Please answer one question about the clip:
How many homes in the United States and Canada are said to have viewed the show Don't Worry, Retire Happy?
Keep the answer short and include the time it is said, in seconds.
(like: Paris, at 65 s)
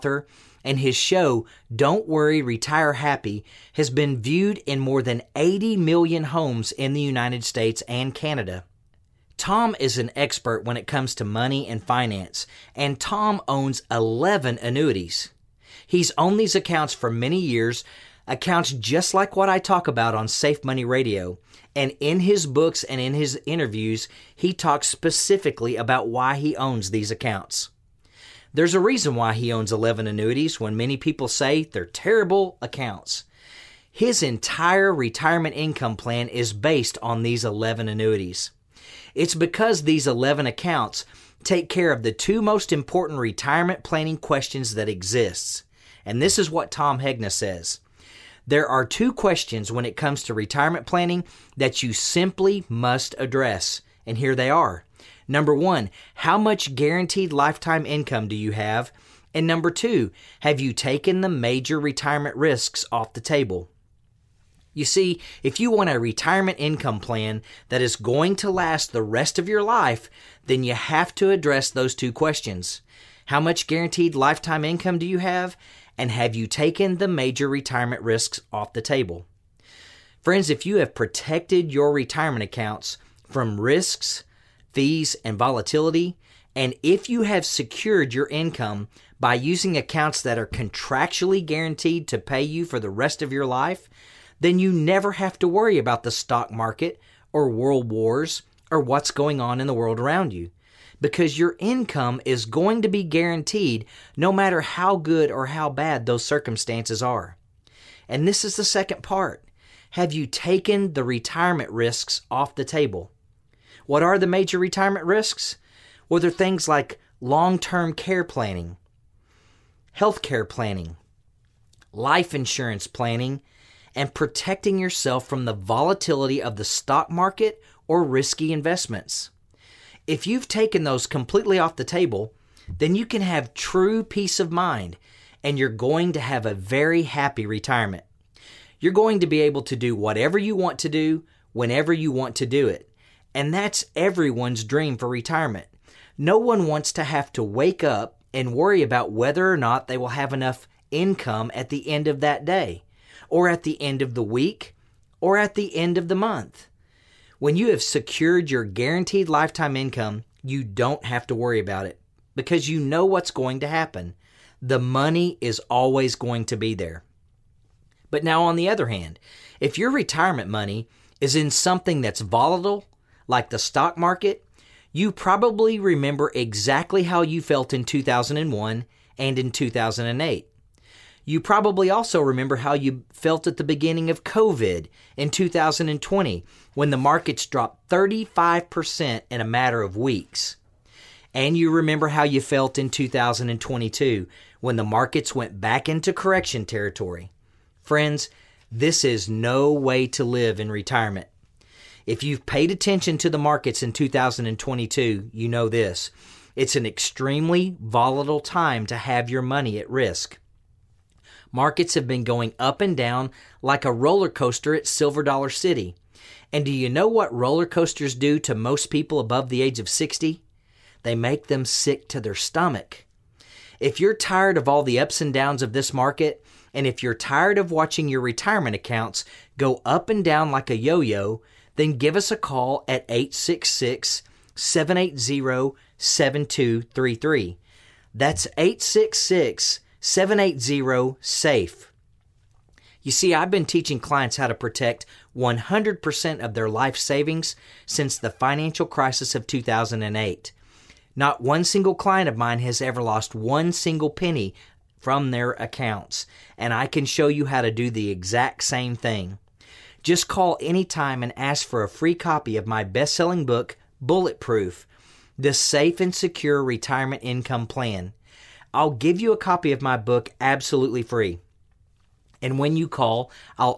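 80 million, at 5 s.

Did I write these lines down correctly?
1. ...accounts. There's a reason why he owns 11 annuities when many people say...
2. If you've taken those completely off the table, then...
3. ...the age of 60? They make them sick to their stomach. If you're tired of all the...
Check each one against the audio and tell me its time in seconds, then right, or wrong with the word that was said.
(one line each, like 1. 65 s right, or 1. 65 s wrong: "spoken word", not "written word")
1. 27 s right
2. 130 s right
3. 219 s right.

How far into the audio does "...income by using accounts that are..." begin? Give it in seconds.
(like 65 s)
88 s.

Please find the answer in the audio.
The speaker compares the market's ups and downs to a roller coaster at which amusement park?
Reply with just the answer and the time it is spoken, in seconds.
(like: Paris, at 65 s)
Silver Dollar City, at 214 s.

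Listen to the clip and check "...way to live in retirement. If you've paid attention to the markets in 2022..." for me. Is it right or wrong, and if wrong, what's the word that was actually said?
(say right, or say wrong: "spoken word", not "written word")
right.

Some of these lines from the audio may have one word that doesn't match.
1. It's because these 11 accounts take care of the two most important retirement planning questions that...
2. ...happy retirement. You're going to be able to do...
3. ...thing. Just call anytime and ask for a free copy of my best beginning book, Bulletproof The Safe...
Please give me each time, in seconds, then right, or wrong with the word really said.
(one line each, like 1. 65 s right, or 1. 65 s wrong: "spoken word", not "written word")
1. 39 s right
2. 137 s right
3. 258 s wrong: "selling", not "beginning".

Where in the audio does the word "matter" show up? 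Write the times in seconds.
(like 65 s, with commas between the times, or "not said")
104 s, 189 s.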